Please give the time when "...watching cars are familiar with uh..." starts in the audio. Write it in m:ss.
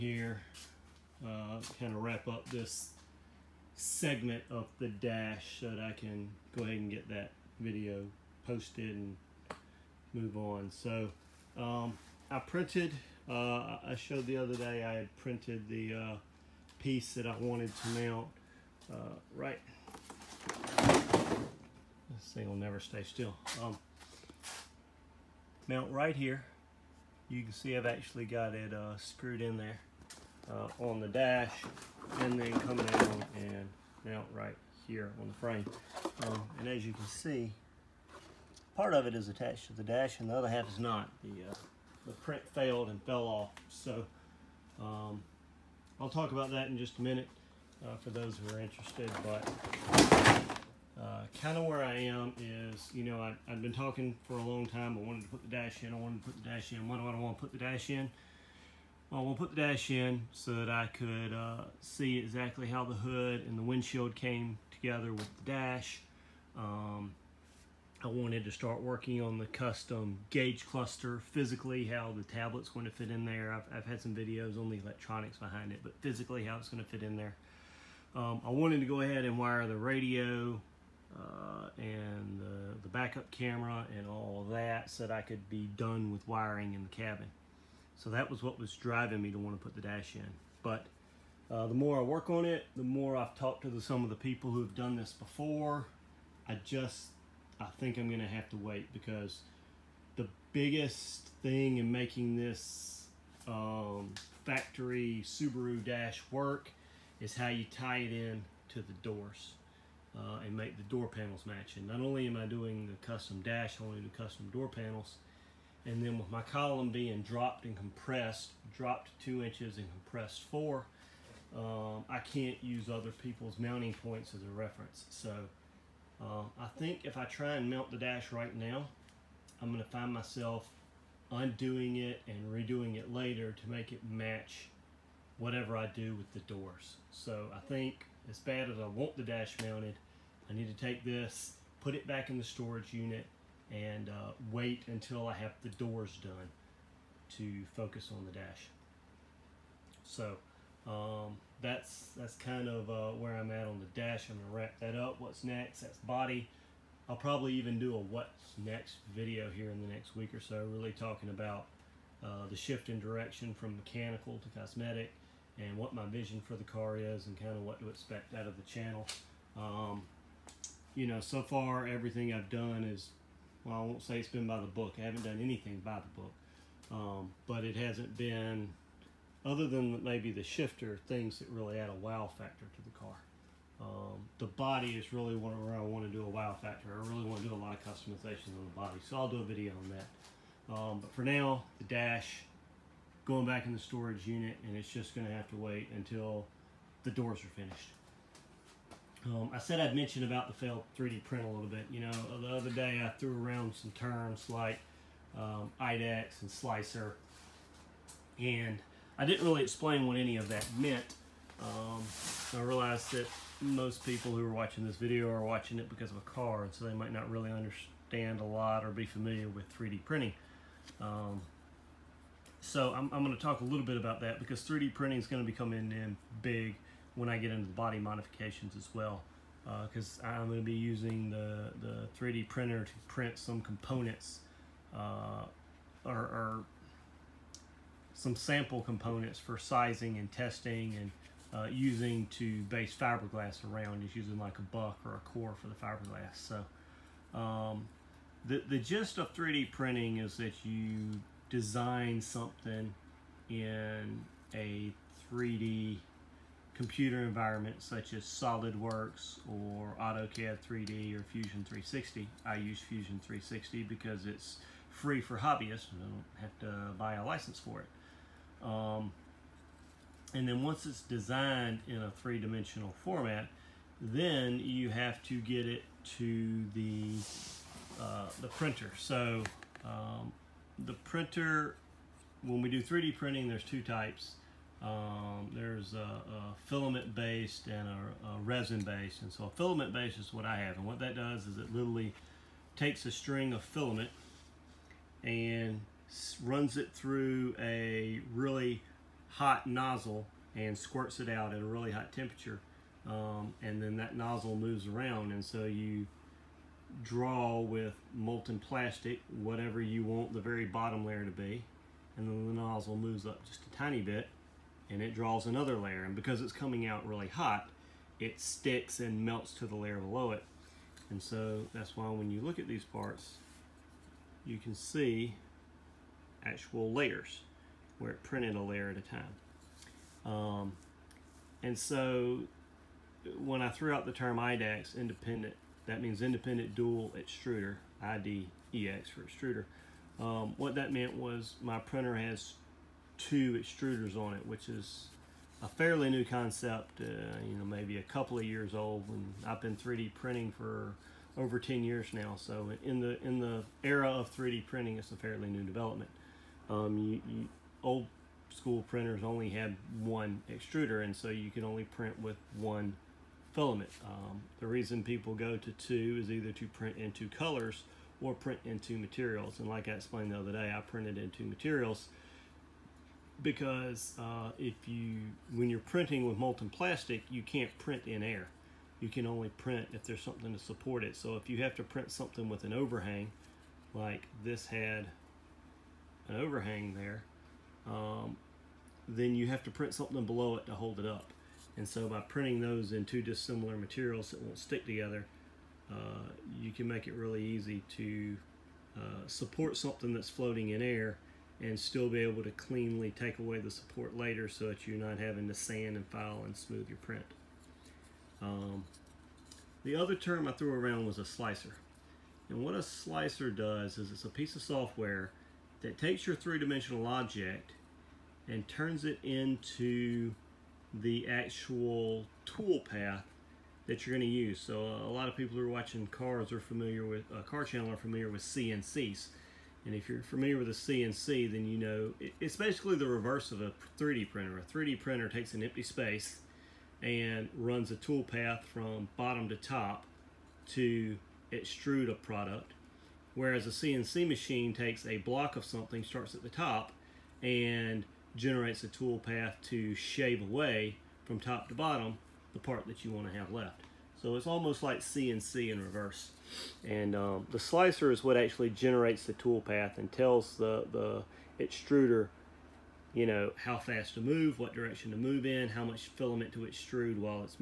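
7:05.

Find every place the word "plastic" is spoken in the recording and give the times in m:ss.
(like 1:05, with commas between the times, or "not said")
5:08, 6:16.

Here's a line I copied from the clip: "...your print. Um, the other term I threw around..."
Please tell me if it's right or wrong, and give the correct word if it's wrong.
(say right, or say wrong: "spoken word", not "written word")
right.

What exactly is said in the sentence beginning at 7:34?
So it's almost like CNC in reverse.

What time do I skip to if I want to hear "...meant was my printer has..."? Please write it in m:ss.
5:40.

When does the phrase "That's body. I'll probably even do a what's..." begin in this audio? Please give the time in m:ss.
2:35.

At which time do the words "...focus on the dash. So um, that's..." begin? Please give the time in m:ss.
2:27.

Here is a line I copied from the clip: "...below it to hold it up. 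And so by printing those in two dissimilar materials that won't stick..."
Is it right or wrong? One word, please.
right.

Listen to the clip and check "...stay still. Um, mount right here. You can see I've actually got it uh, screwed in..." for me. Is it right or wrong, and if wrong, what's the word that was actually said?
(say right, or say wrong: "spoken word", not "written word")
right.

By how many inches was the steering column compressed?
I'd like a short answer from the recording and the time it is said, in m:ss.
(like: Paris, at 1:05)
4, at 1:59.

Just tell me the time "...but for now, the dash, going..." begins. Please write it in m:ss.
3:11.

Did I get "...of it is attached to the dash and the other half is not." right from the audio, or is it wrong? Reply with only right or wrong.
right.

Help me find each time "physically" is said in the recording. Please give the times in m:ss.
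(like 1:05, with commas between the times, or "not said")
1:11, 1:16.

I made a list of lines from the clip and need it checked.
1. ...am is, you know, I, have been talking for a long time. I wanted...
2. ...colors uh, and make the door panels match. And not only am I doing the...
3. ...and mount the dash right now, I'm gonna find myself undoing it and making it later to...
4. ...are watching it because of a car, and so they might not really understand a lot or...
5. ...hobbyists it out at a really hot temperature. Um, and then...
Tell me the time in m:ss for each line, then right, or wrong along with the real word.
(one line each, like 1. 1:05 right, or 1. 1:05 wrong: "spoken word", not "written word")
1. 0:51 right
2. 1:49 wrong: "doors", not "colors"
3. 2:07 wrong: "redoing", not "making"
4. 3:35 right
5. 5:00 wrong: "squirts", not "hobbyists".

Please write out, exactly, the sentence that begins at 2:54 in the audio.
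I haven't done anything by the book.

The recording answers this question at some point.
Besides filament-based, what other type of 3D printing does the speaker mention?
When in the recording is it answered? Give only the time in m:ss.
4:48.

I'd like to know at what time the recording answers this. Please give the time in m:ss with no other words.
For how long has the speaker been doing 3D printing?
5:51.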